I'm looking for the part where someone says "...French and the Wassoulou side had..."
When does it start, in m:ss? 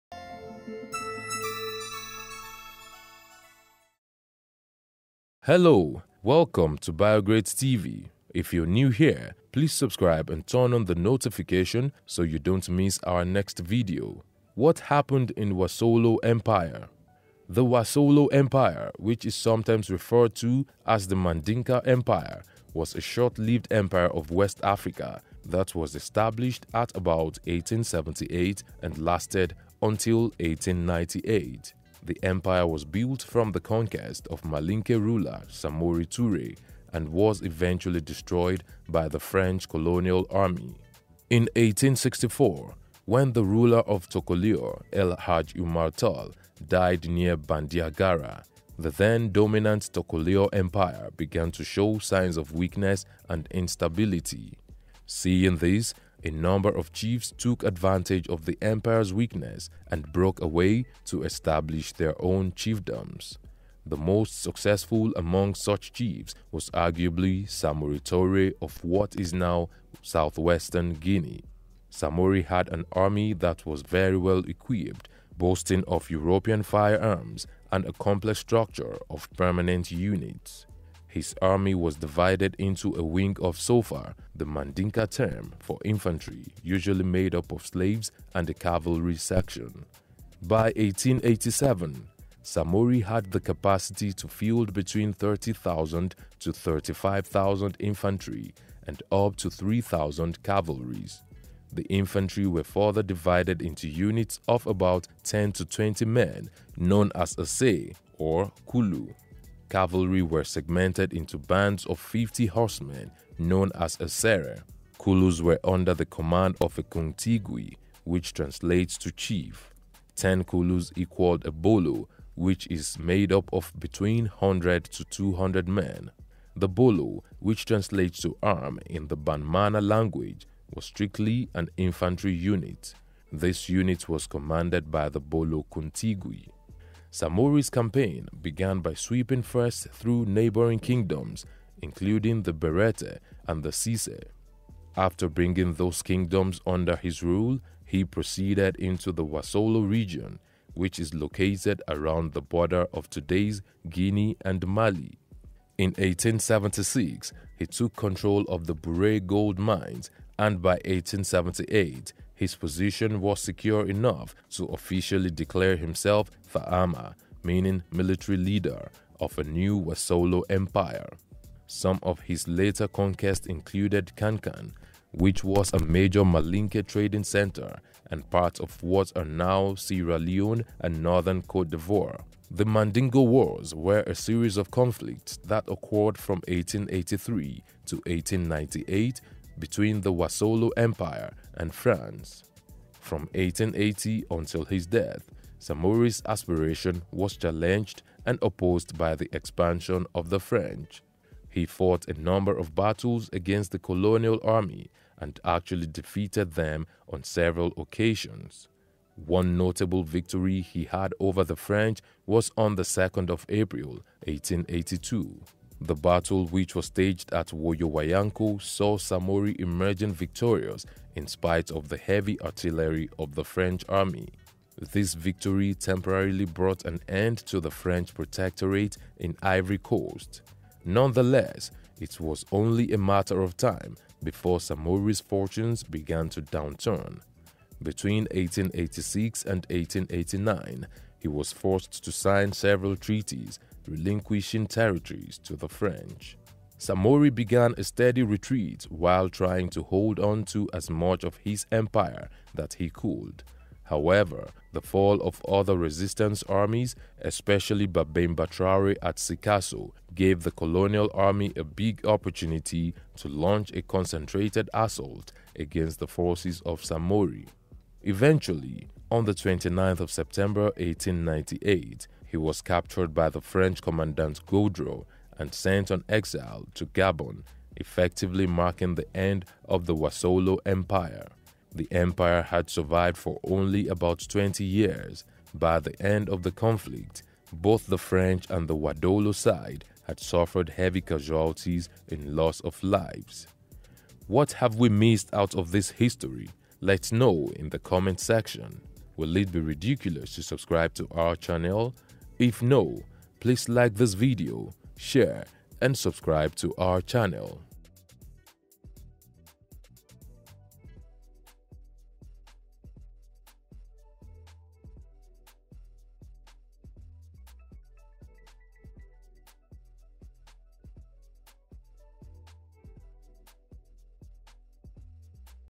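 4:47.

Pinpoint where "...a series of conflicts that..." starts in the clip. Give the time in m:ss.
3:04.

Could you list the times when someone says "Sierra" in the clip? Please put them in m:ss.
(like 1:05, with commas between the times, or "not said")
2:59.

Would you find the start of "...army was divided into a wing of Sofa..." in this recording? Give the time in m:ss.
1:21.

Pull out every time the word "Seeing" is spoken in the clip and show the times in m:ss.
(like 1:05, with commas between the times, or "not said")
0:55.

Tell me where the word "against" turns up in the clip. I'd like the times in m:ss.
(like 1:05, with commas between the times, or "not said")
3:23, 4:25.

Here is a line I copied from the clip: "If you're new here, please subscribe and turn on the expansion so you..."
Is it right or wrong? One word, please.
wrong.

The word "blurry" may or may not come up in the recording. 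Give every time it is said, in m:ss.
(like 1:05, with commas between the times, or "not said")
not said.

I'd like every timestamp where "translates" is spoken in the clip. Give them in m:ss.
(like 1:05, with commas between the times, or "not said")
1:58, 2:07.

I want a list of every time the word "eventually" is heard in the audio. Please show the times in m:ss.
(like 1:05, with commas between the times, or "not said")
0:37, 4:28.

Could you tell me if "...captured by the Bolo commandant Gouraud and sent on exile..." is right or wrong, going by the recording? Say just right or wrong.
wrong.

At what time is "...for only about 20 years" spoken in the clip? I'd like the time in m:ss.
4:43.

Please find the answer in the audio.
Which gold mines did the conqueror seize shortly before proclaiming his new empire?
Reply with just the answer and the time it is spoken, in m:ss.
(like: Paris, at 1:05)
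Bure gold mines, at 2:38.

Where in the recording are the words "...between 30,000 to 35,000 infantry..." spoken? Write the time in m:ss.
1:34.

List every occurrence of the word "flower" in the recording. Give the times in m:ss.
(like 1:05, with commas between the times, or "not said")
not said.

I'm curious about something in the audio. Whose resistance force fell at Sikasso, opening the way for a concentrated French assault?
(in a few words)
Babemba Traore.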